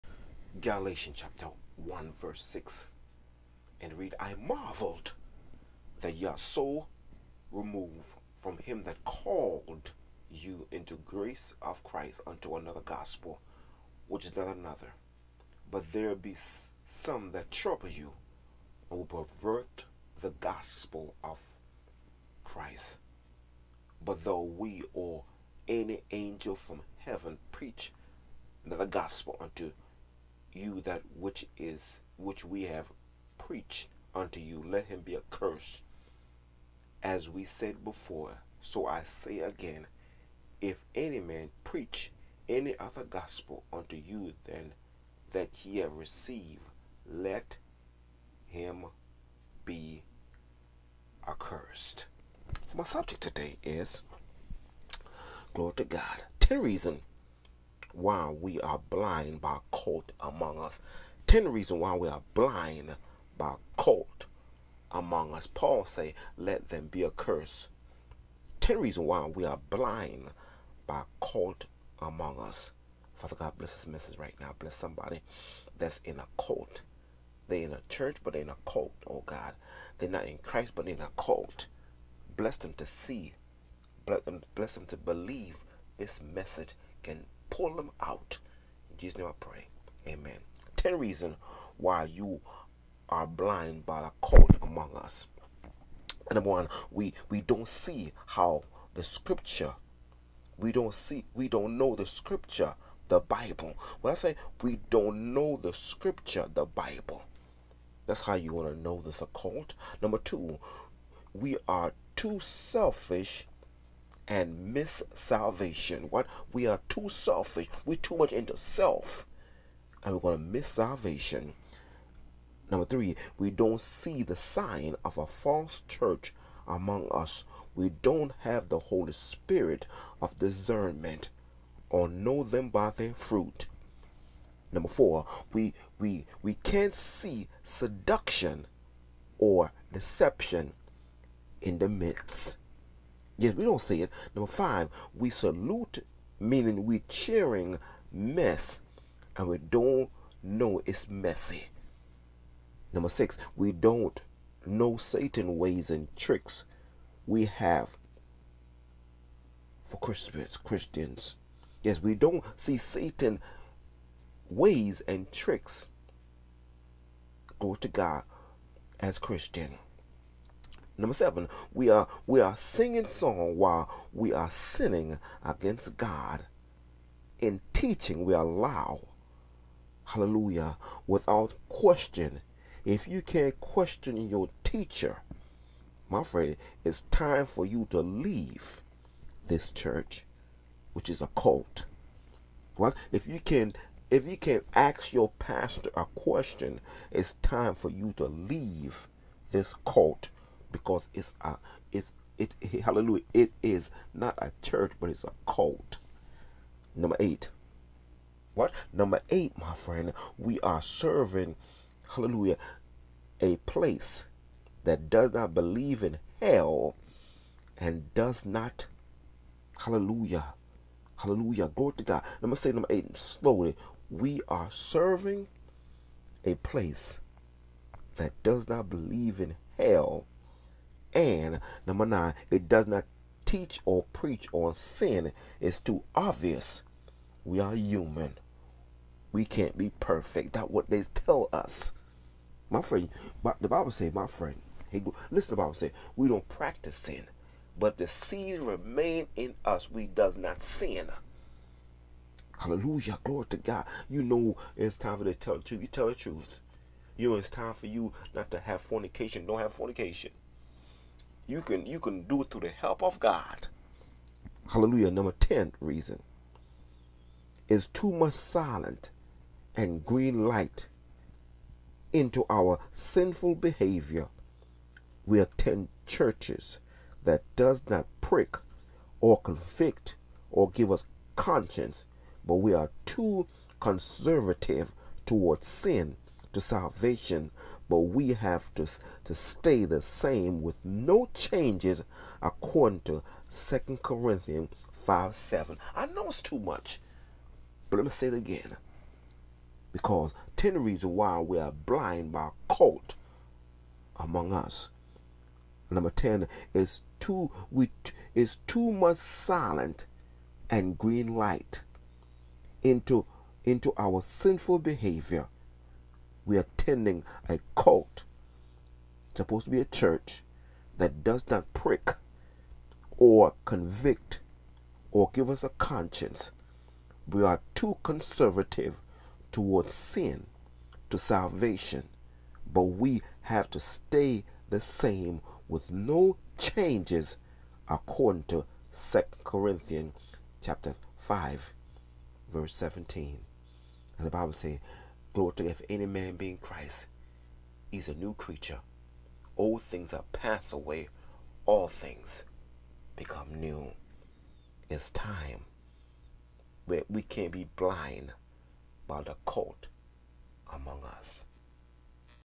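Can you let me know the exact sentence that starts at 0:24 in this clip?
But though we or any angel from heaven preach the gospel unto you that which is which we have preached unto you.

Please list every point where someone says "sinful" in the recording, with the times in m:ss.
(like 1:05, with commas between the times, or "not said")
4:32, 5:14.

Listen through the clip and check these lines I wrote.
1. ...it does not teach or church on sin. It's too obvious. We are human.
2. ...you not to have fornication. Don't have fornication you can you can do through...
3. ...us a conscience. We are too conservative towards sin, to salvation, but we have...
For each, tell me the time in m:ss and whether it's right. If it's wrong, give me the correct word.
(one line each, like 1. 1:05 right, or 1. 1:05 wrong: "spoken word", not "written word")
1. 3:52 wrong: "preach", not "church"
2. 4:17 right
3. 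5:25 right.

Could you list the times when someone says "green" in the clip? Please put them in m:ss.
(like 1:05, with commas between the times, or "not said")
4:30, 5:10.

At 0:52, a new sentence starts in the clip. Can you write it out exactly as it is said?
My subject today is glory to God.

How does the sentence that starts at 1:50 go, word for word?
Number two, we are too selfish and miss salvation.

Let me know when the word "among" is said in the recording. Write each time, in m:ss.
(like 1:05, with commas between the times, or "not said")
1:00, 1:04, 1:12, 1:34, 2:06, 5:04, 6:00.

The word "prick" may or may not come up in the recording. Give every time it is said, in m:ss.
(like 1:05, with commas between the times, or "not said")
4:38, 5:21.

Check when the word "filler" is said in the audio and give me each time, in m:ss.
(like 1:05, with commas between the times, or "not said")
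not said.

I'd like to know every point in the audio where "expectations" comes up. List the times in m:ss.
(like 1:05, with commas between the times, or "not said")
not said.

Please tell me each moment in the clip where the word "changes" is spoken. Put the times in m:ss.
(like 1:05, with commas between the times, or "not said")
4:51, 5:36.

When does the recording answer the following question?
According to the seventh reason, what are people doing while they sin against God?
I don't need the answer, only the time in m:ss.
2:52.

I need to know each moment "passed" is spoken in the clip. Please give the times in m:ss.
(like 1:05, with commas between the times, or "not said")
5:50.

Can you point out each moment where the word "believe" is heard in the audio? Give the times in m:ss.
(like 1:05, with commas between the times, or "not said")
1:24, 3:35, 3:48.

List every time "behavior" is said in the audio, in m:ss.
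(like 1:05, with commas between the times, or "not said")
4:33, 5:14.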